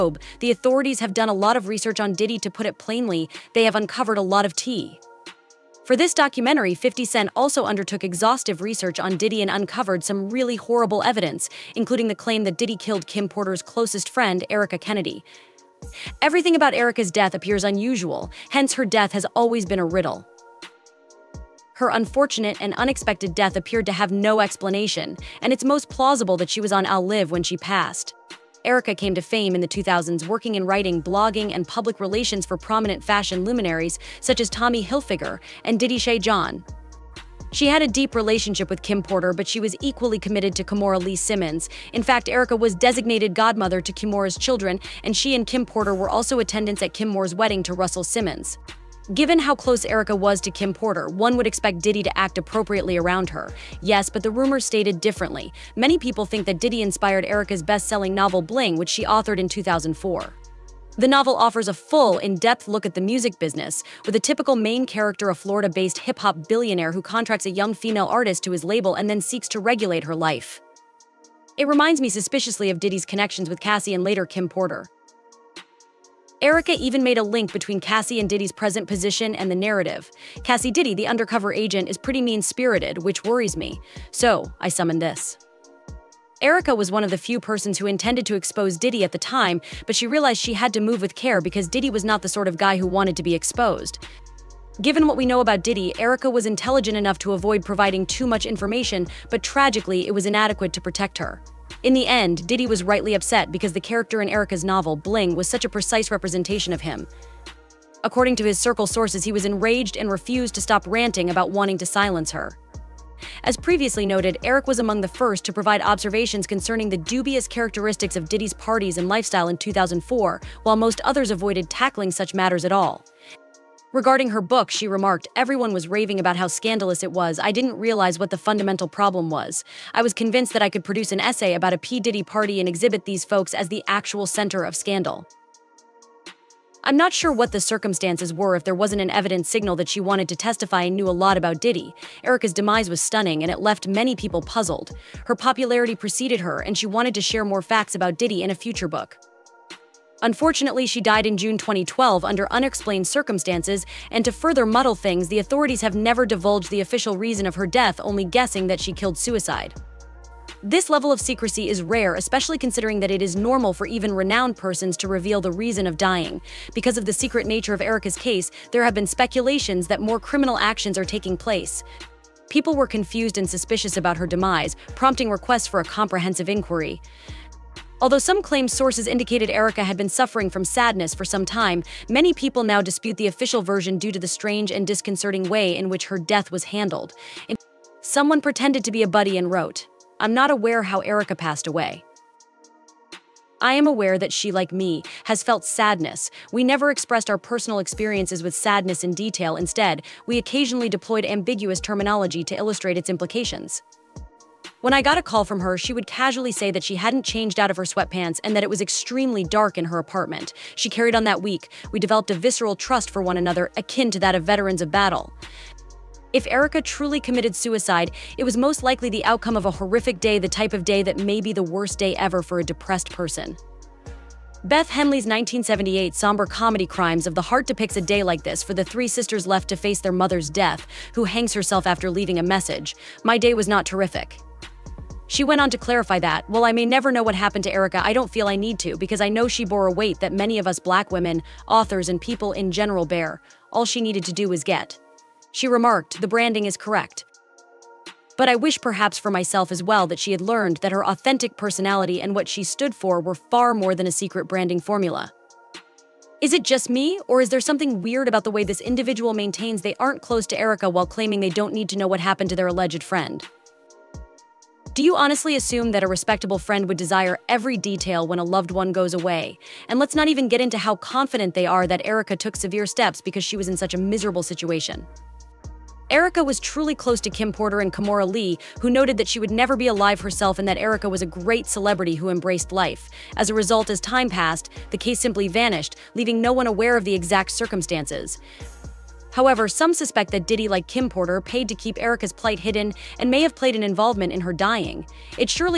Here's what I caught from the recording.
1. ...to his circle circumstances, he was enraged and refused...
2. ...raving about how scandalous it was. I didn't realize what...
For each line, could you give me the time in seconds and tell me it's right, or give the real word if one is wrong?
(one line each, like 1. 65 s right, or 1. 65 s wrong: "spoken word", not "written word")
1. 108 s wrong: "sources", not "circumstances"
2. 125 s right.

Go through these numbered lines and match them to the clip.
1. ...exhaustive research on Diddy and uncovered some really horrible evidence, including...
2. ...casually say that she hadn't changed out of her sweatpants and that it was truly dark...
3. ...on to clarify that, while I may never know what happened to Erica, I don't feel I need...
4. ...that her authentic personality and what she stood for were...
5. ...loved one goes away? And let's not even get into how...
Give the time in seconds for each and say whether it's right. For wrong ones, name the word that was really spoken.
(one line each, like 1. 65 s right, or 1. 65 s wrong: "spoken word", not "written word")
1. 8 s right
2. 206 s wrong: "extremely", not "truly"
3. 235 s right
4. 250 s right
5. 268 s right.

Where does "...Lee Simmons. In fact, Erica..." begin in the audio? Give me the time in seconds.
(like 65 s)
41 s.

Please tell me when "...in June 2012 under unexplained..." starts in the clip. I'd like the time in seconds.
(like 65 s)
151 s.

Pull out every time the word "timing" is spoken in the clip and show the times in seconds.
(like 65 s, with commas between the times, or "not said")
not said.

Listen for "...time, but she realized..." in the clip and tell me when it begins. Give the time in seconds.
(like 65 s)
89 s.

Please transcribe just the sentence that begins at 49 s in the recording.
Given how close Erica was to Kim Porter, one would expect Diddy to act appropriately around her.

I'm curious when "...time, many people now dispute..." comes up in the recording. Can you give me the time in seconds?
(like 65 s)
181 s.